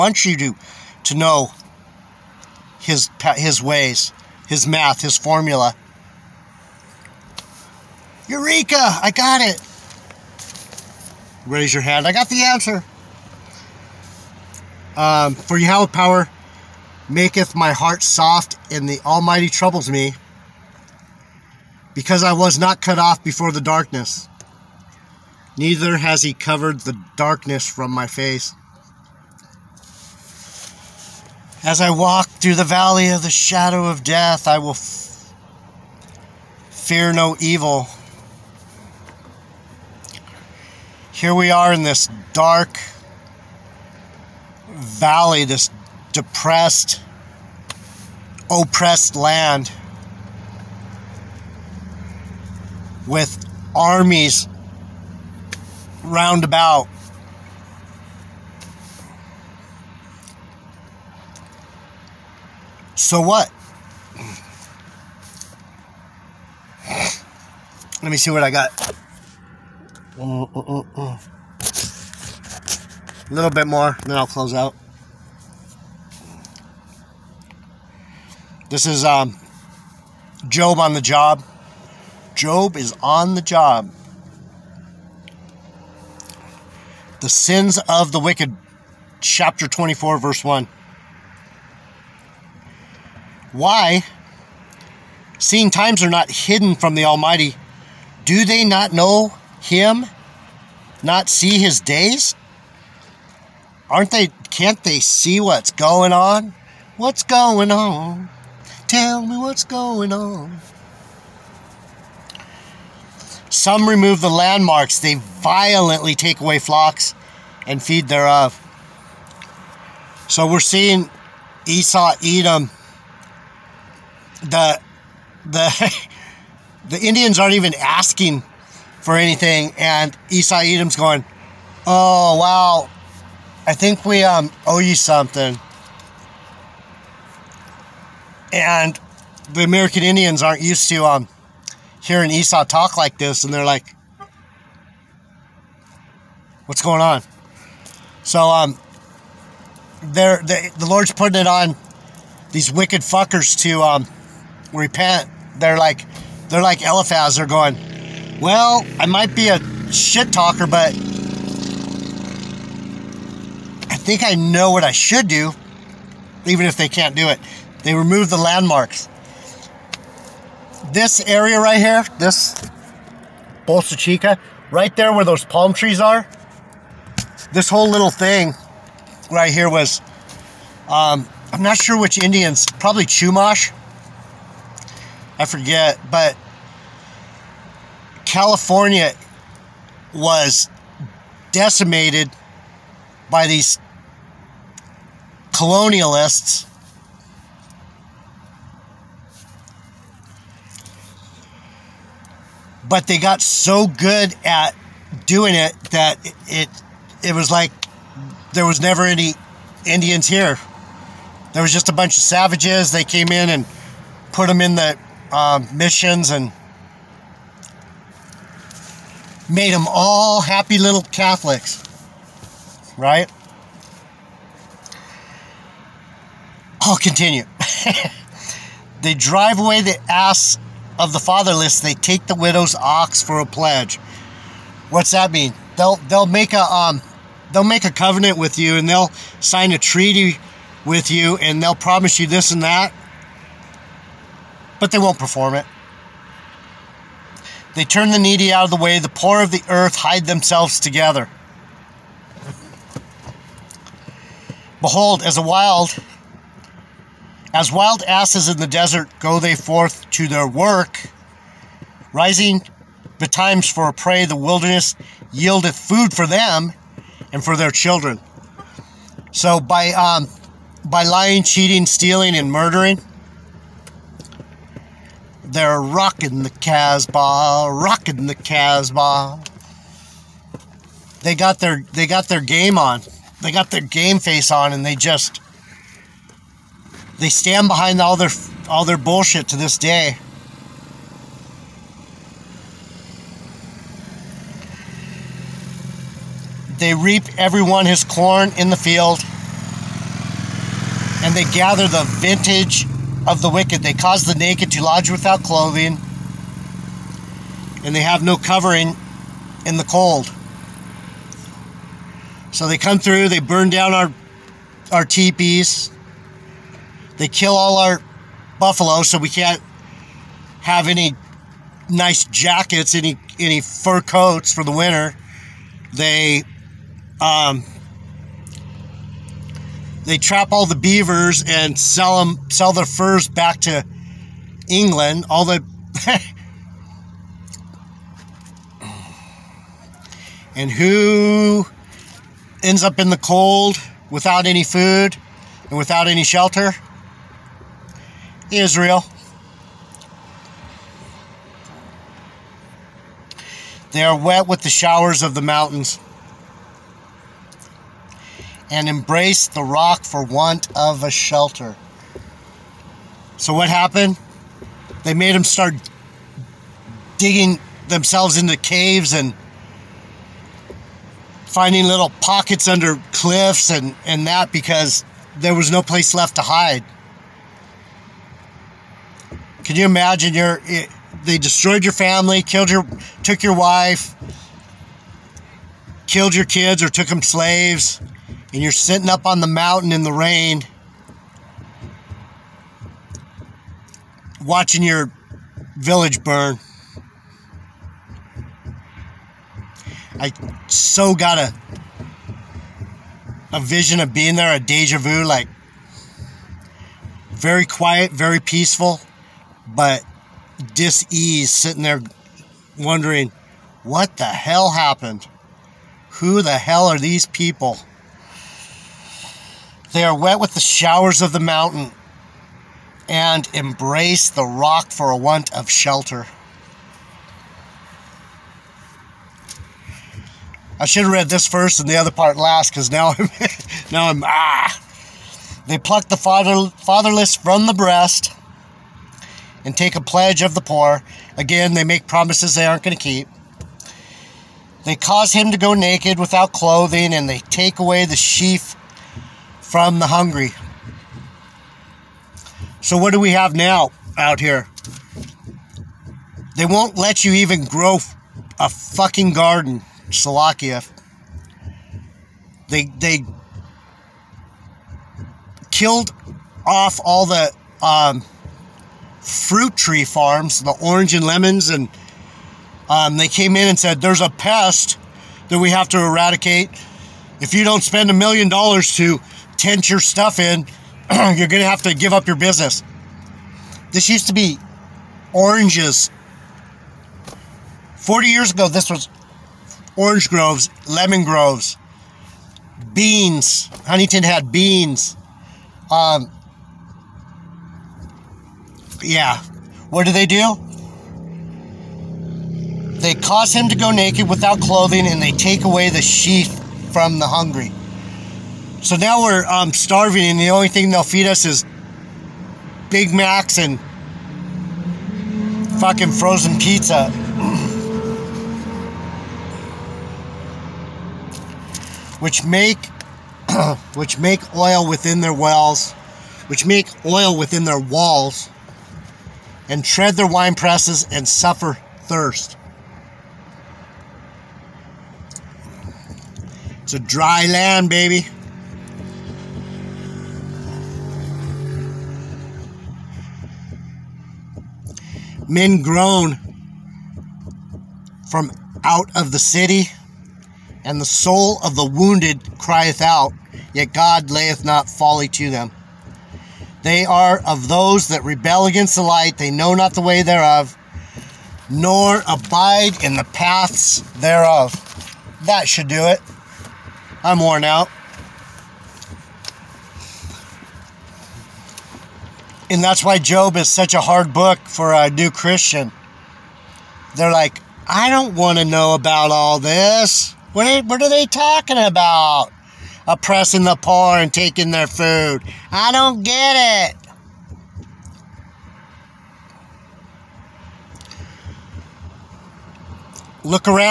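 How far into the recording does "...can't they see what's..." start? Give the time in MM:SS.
01:44.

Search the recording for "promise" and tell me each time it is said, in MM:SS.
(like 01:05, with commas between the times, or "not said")
04:01, 07:22.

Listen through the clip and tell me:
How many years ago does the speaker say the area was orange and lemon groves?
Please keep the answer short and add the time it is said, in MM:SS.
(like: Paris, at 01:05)
40, at 08:07.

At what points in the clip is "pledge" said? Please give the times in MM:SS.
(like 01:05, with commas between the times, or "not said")
03:53, 07:20.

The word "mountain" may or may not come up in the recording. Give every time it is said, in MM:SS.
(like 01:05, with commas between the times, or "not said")
05:55, 06:29, 07:01.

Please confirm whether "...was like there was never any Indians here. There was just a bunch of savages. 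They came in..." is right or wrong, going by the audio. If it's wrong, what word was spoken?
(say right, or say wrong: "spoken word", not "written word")
right.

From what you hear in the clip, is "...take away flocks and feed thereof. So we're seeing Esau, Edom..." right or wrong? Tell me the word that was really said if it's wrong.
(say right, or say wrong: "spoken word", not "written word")
right.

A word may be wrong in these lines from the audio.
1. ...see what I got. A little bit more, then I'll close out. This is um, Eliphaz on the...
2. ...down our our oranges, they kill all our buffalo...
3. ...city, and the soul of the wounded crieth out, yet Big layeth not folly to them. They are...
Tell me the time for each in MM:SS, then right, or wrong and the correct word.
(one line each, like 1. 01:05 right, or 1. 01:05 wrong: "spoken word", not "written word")
1. 01:08 wrong: "Job", not "Eliphaz"
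2. 05:13 wrong: "teepees", not "oranges"
3. 09:09 wrong: "God", not "Big".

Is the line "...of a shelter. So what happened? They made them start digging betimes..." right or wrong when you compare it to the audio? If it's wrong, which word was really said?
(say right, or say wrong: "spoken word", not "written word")
wrong: "themselves", not "betimes".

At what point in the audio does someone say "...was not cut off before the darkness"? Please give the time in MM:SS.
00:22.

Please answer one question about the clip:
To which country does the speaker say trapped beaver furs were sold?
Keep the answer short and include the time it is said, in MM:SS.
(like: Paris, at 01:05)
England, at 05:34.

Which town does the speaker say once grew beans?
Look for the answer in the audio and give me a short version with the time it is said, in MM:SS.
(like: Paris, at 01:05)
Huntington, at 08:13.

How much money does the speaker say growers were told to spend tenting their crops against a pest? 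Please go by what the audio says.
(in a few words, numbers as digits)
a million dollars.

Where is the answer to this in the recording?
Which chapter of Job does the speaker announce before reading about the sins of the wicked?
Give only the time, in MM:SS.
01:29.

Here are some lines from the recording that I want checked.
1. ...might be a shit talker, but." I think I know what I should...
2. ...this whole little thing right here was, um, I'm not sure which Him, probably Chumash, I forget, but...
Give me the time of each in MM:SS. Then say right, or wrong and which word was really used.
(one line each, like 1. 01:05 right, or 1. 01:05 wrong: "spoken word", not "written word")
1. 02:39 right
2. 02:57 wrong: "Indians", not "Him".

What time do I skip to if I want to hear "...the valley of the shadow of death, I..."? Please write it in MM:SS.
00:32.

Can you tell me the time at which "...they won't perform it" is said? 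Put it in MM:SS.
04:04.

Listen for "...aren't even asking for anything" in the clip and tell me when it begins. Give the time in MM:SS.
02:07.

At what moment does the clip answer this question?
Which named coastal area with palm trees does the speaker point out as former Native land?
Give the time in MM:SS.
02:53.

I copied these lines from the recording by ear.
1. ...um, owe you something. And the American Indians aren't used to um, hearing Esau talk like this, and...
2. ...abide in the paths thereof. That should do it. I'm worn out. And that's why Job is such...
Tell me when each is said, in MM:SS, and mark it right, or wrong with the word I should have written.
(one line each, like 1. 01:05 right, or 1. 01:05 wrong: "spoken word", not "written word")
1. 02:14 right
2. 09:22 right.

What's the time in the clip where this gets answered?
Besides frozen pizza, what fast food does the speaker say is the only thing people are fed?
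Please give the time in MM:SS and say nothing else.
08:32.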